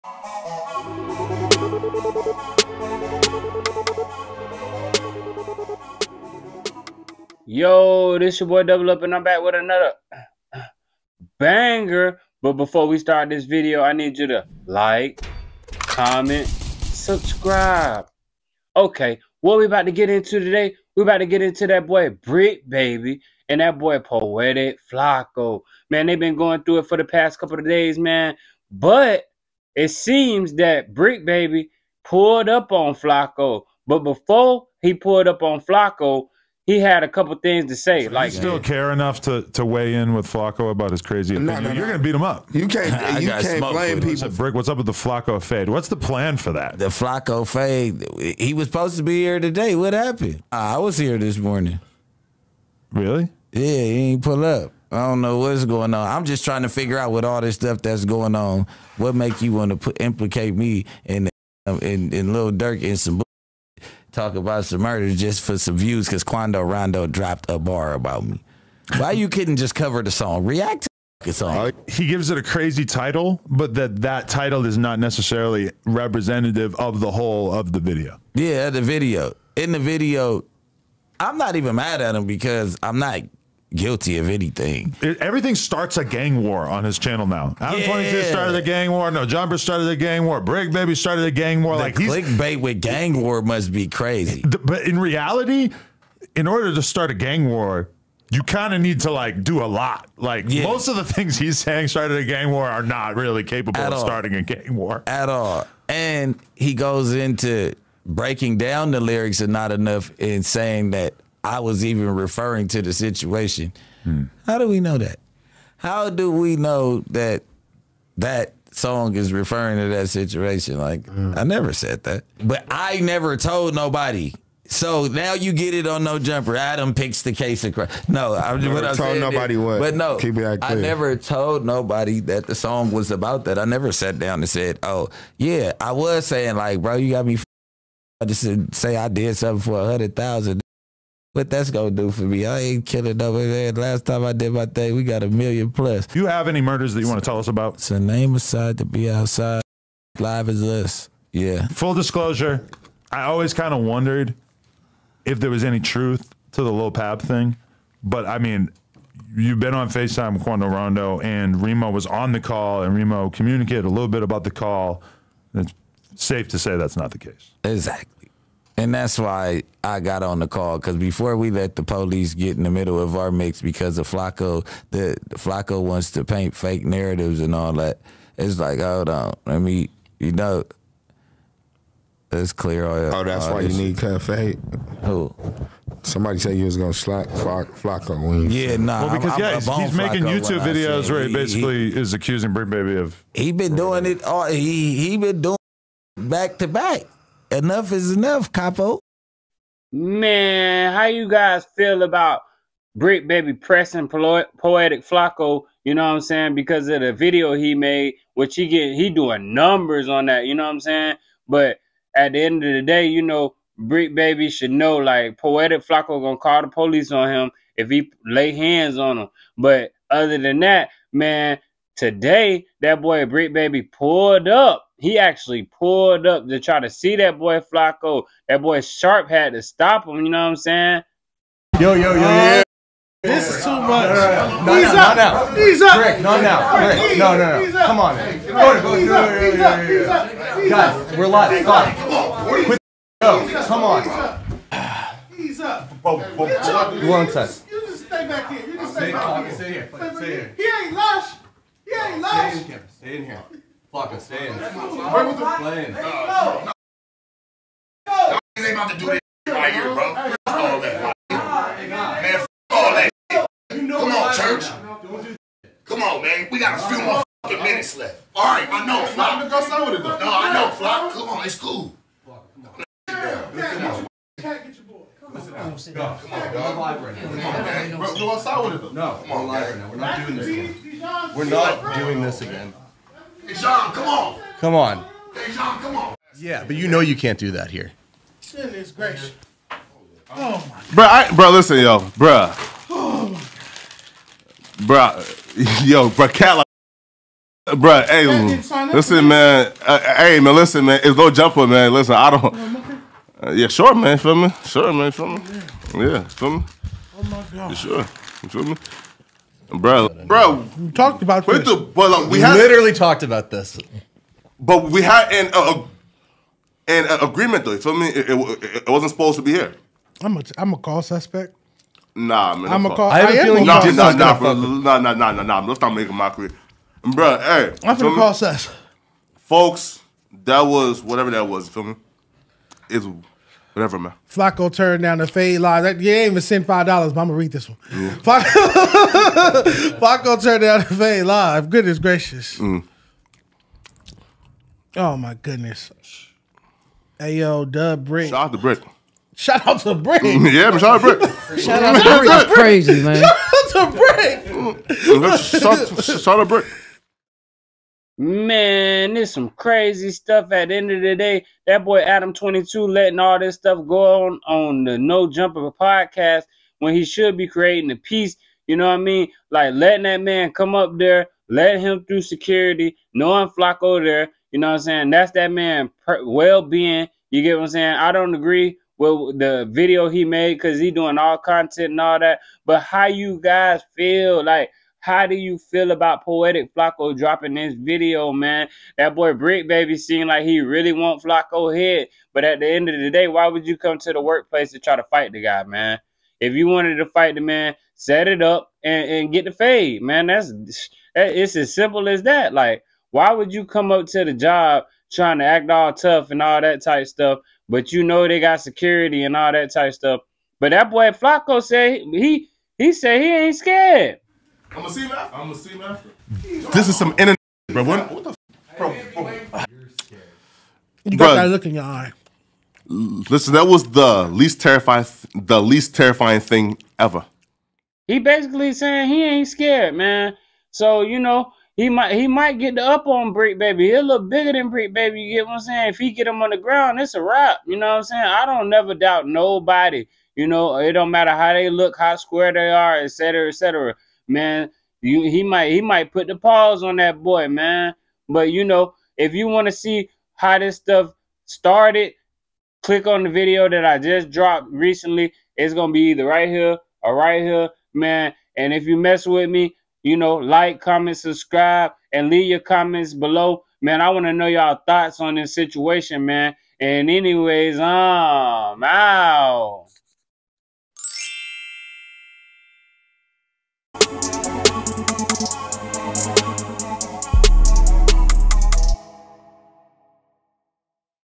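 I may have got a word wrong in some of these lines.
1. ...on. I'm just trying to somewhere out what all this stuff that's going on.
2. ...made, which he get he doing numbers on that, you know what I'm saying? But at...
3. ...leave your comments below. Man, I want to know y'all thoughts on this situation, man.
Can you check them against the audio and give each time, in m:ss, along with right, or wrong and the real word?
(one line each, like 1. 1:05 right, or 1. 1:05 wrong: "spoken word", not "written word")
1. 0:55 wrong: "figure", not "somewhere"
2. 3:27 right
3. 7:42 right.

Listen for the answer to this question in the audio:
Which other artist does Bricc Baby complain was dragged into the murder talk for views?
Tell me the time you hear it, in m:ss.
1:02.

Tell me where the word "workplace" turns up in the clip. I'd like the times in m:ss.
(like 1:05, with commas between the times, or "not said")
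6:34.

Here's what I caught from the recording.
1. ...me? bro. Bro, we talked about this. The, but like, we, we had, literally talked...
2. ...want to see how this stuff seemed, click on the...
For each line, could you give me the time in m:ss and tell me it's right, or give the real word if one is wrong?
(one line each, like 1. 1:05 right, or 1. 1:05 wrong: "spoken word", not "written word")
1. 5:08 right
2. 7:29 wrong: "started", not "seemed".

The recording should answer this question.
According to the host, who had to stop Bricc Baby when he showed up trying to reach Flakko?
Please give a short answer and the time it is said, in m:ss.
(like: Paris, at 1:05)
Sharp, at 3:48.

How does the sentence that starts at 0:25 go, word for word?
Man, they've been going through it for the past couple of days, man.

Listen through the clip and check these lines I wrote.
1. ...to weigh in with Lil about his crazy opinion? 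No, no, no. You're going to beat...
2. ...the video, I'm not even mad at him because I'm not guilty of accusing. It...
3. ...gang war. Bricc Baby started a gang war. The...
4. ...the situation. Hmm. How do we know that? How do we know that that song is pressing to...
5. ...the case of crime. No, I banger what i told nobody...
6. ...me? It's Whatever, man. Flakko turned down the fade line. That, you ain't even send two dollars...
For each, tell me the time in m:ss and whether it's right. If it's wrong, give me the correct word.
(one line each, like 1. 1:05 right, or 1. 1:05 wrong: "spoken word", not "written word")
1. 0:39 wrong: "Flakko", not "Lil"
2. 1:19 wrong: "anything", not "accusing"
3. 1:29 right
4. 1:52 wrong: "referring", not "pressing"
5. 2:07 wrong: "never", not "banger"
6. 5:31 wrong: "five", not "two".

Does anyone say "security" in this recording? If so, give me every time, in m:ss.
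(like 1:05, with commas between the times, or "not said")
6:12, 6:48.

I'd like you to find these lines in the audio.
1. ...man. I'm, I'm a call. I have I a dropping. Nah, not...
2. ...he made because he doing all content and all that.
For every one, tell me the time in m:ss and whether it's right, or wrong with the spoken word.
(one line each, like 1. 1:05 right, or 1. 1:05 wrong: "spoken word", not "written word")
1. 5:22 wrong: "feeling", not "dropping"
2. 6:20 right.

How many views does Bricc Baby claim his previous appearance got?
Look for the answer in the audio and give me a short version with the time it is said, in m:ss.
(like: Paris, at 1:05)
a million plus, at 2:25.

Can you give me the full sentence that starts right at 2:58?
It's like, hold on, let me, you know, let's clear all.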